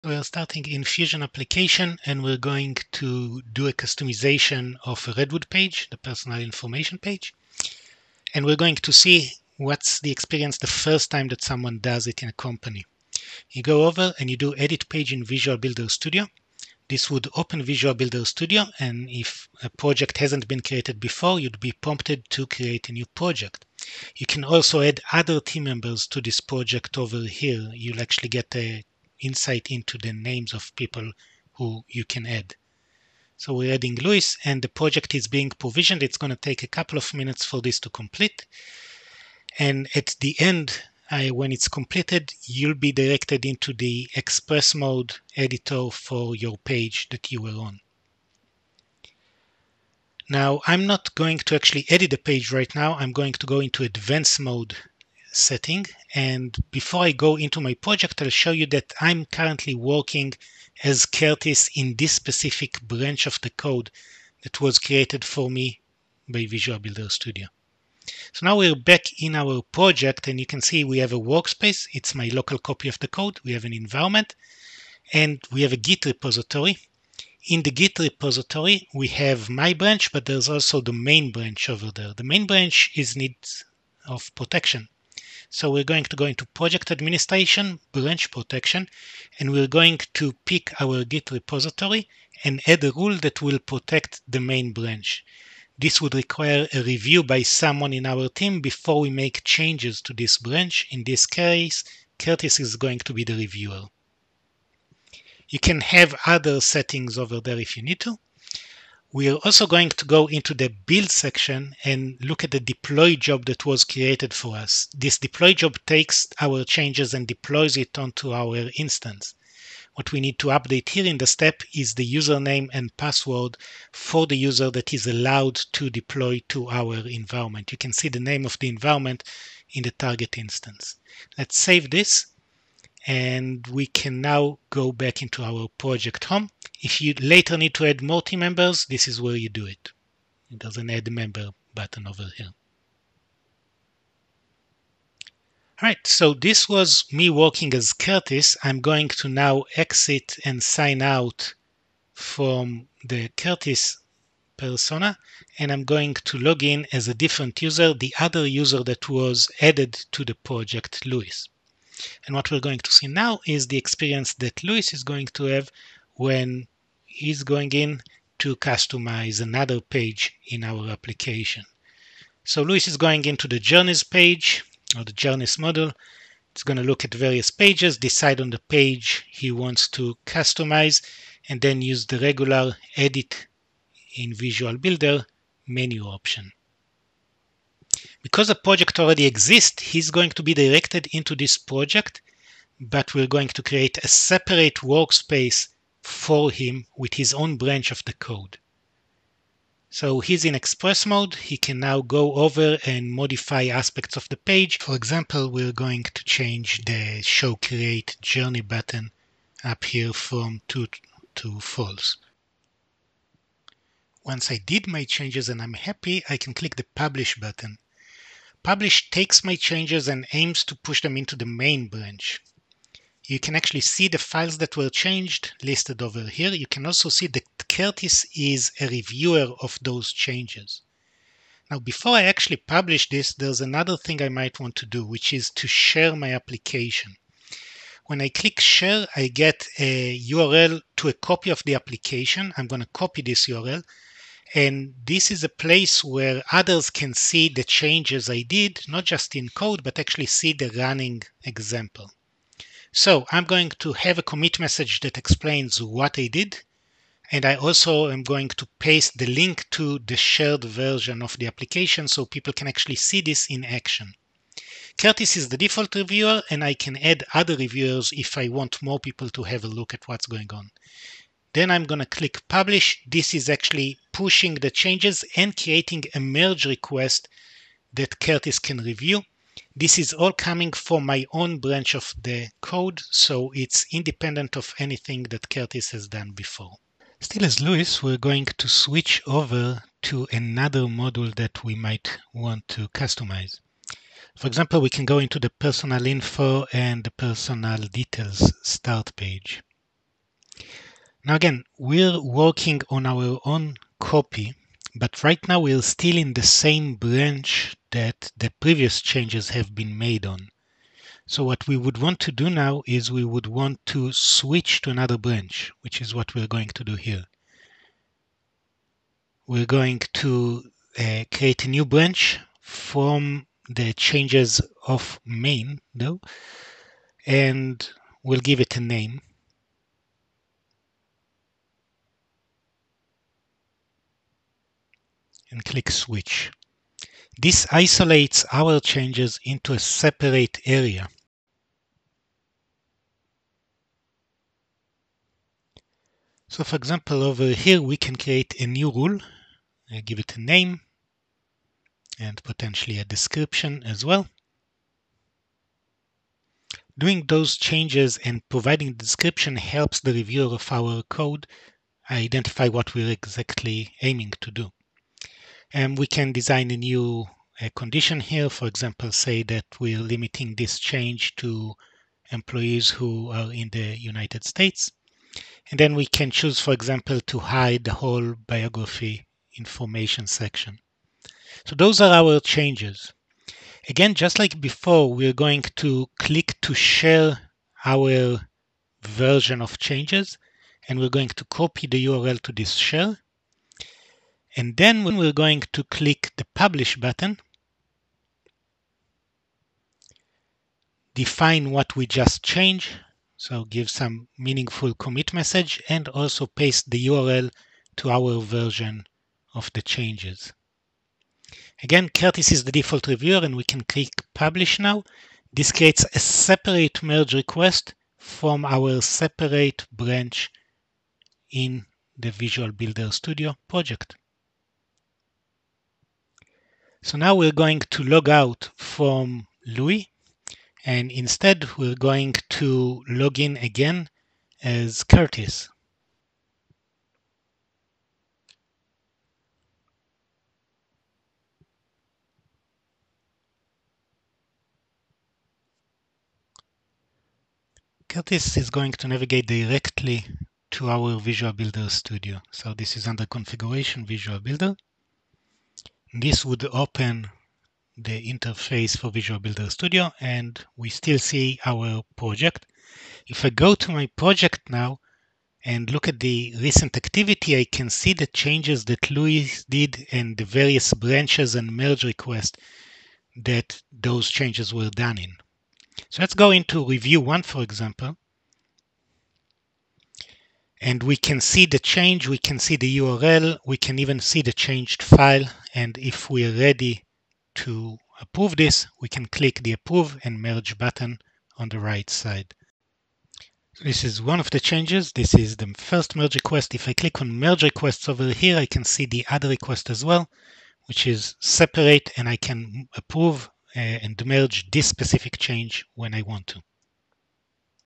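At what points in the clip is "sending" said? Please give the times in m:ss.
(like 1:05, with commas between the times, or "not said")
not said.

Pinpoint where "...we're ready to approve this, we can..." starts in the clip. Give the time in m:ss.
8:06.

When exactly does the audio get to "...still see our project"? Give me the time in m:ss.
7:40.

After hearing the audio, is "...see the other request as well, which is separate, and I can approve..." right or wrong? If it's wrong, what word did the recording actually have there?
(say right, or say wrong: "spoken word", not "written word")
right.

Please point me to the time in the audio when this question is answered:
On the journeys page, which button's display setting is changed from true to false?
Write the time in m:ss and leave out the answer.
3:27.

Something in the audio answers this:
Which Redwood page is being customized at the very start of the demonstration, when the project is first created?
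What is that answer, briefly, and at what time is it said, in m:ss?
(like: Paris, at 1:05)
Personal information page, at 0:05.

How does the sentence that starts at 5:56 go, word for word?
Doing those changes and providing the description helps the reviewer of our code identify what we're exactly aiming to do.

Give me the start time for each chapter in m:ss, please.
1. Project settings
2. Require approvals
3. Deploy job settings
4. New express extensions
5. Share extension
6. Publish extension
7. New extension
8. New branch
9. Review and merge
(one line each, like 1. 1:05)
1. 0:50
2. 1:20
3. 1:45
4. 2:50
5. 3:55
6. 4:10
7. 4:50
8. 5:05
9. 7:30.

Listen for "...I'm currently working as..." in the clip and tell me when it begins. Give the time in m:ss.
0:58.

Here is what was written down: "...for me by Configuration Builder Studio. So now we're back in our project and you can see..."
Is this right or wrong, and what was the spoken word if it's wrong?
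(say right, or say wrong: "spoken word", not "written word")
wrong: "Visual", not "Configuration".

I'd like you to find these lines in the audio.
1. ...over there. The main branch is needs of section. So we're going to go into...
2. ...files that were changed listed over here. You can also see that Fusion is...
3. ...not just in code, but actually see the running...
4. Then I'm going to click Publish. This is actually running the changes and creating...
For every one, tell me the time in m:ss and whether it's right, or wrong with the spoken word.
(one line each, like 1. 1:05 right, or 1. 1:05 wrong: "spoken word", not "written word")
1. 1:21 wrong: "protection", not "section"
2. 3:44 wrong: "Curtis", not "Fusion"
3. 4:08 right
4. 4:31 wrong: "pushing", not "running".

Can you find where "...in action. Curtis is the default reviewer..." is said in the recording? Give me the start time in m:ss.
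4:23.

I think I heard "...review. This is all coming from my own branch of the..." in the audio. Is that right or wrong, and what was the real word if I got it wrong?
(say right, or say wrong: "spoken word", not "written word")
right.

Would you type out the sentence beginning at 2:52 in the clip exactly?
So Luis is going into the journeys page or the journeys model.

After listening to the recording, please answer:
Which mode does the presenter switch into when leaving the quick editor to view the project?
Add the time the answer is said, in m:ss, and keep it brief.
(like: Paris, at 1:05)
Advanced mode, at 0:53.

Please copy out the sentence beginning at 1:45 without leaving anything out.
You can have other settings over there if you need to.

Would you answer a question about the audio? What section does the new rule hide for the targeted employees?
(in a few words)
Biography information.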